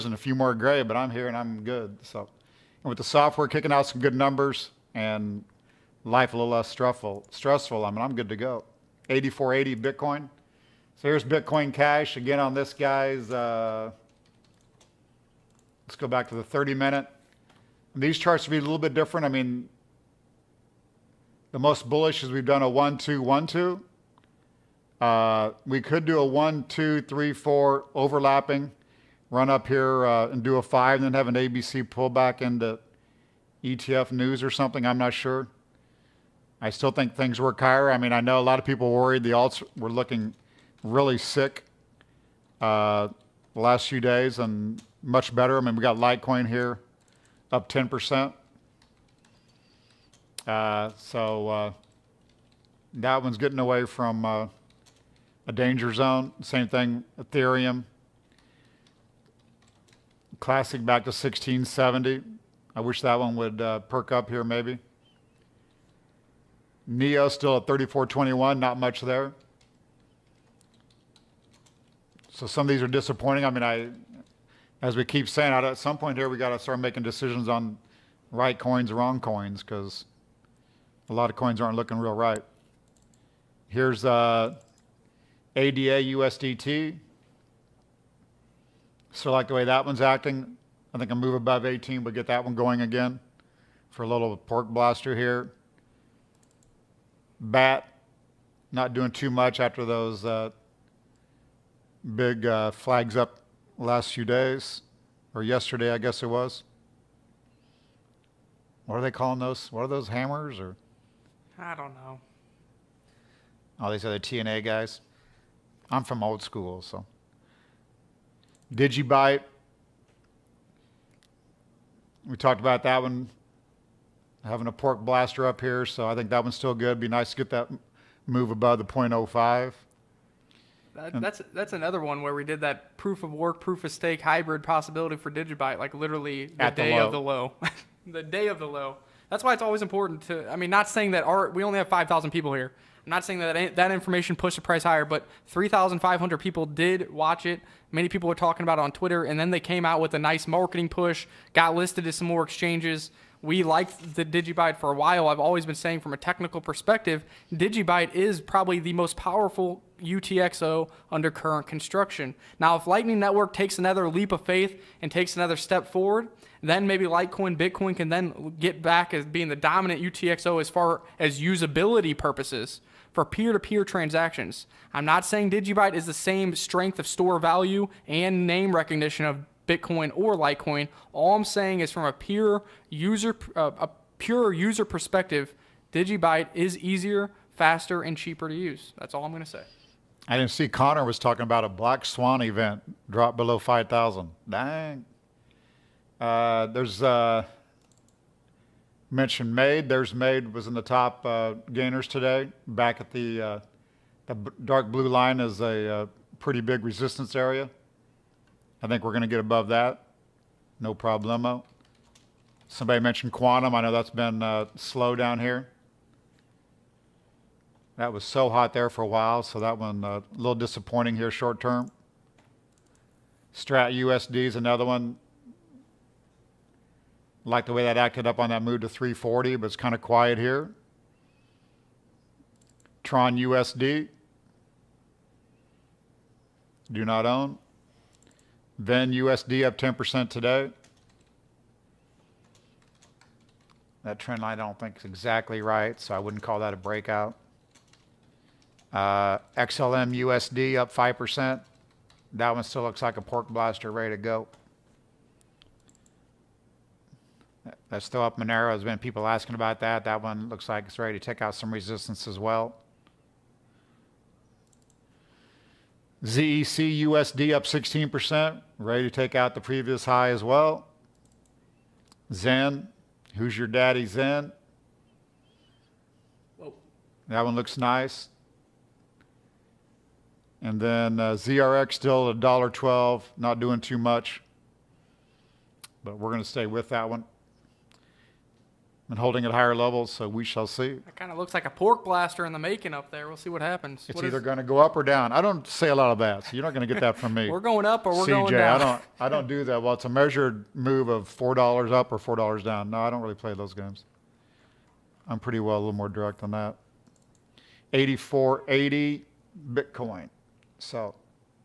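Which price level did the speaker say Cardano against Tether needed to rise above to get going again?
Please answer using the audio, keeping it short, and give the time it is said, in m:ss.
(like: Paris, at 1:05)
18, at 1:31.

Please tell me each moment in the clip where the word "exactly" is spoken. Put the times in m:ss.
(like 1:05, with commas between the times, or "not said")
4:05.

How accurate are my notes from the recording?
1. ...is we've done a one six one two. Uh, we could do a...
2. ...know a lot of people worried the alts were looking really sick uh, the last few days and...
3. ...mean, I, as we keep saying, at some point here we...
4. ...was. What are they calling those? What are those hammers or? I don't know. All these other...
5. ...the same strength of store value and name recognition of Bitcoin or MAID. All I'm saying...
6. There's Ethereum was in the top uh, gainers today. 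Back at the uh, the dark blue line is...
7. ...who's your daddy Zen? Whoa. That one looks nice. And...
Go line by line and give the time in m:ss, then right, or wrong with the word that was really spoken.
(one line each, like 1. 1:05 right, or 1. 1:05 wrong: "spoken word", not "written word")
1. 0:22 wrong: "two", not "six"
2. 0:38 right
3. 1:13 right
4. 1:46 right
5. 2:56 wrong: "Litecoin", not "MAID"
6. 3:19 wrong: "MAID", not "Ethereum"
7. 4:33 right.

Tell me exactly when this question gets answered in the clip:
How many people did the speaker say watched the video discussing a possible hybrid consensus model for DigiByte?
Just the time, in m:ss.
2:25.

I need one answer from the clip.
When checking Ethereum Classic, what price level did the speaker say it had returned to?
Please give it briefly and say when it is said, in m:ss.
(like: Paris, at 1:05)
1670, at 1:01.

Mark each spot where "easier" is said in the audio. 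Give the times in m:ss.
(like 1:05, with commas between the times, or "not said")
3:06.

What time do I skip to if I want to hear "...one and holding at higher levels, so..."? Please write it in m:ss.
4:47.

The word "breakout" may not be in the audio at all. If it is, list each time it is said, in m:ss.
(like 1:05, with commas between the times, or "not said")
4:06.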